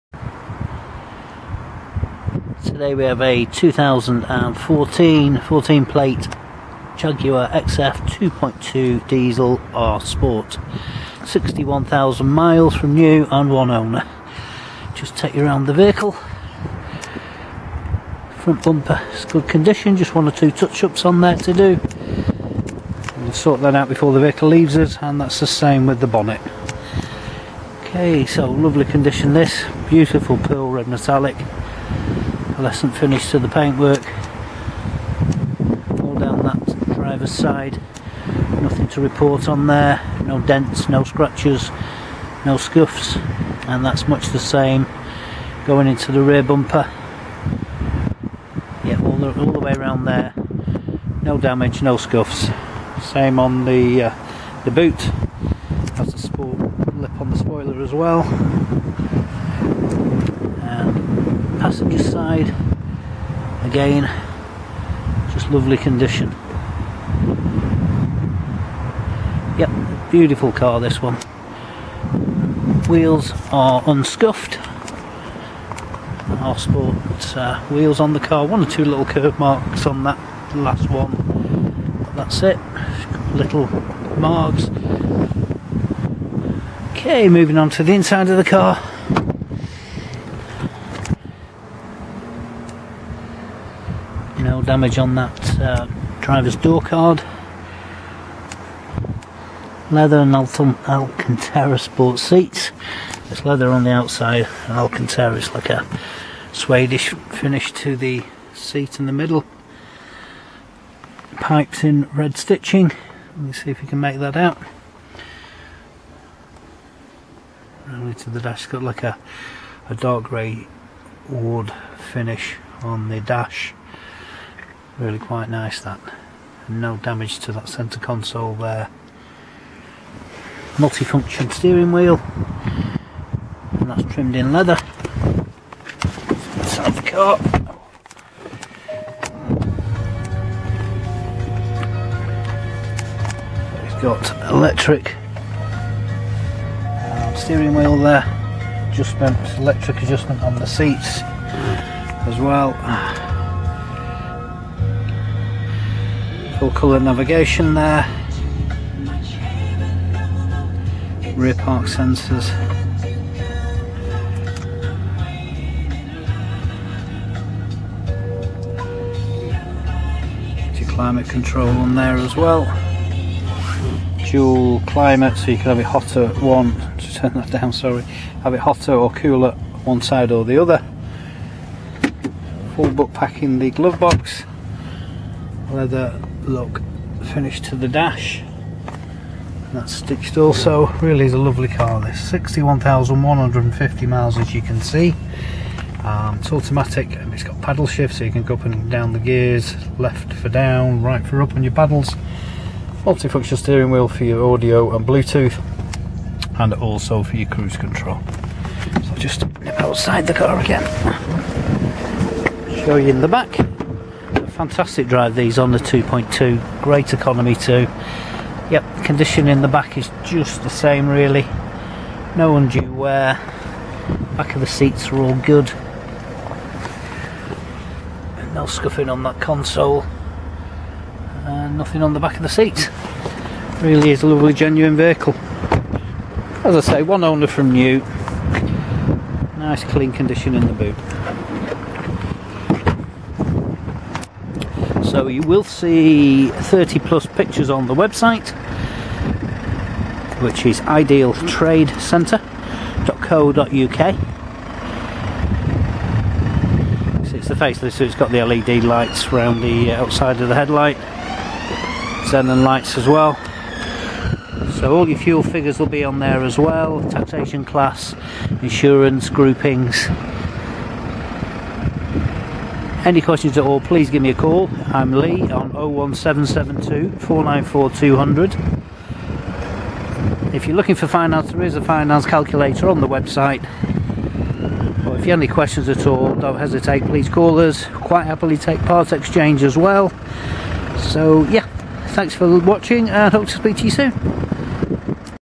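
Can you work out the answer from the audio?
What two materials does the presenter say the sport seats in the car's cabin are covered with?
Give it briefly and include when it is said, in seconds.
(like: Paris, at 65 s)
Leather and Alcantara, at 99 s.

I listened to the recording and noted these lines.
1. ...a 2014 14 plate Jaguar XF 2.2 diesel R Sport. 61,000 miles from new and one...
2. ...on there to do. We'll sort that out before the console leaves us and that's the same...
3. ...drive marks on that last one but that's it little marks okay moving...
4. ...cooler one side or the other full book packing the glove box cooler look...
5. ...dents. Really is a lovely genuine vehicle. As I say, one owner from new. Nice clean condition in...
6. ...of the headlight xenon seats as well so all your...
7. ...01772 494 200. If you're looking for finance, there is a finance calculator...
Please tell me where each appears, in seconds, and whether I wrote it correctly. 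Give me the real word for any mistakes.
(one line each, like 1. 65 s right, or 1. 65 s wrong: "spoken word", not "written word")
1. 3 s right
2. 21 s wrong: "vehicle", not "console"
3. 79 s wrong: "curve", not "drive"
4. 179 s wrong: "leather", not "cooler"
5. 232 s wrong: "seats", not "dents"
6. 260 s wrong: "lights", not "seats"
7. 275 s right.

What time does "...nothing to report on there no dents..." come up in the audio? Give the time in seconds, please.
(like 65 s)
38 s.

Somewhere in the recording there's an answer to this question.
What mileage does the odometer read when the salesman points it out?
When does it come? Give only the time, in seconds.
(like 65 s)
192 s.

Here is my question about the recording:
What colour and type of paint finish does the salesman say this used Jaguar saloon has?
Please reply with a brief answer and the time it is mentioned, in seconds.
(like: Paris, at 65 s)
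Pearl red metallic, at 30 s.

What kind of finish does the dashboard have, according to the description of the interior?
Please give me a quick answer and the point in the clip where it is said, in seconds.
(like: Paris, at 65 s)
Dark grey wood, at 119 s.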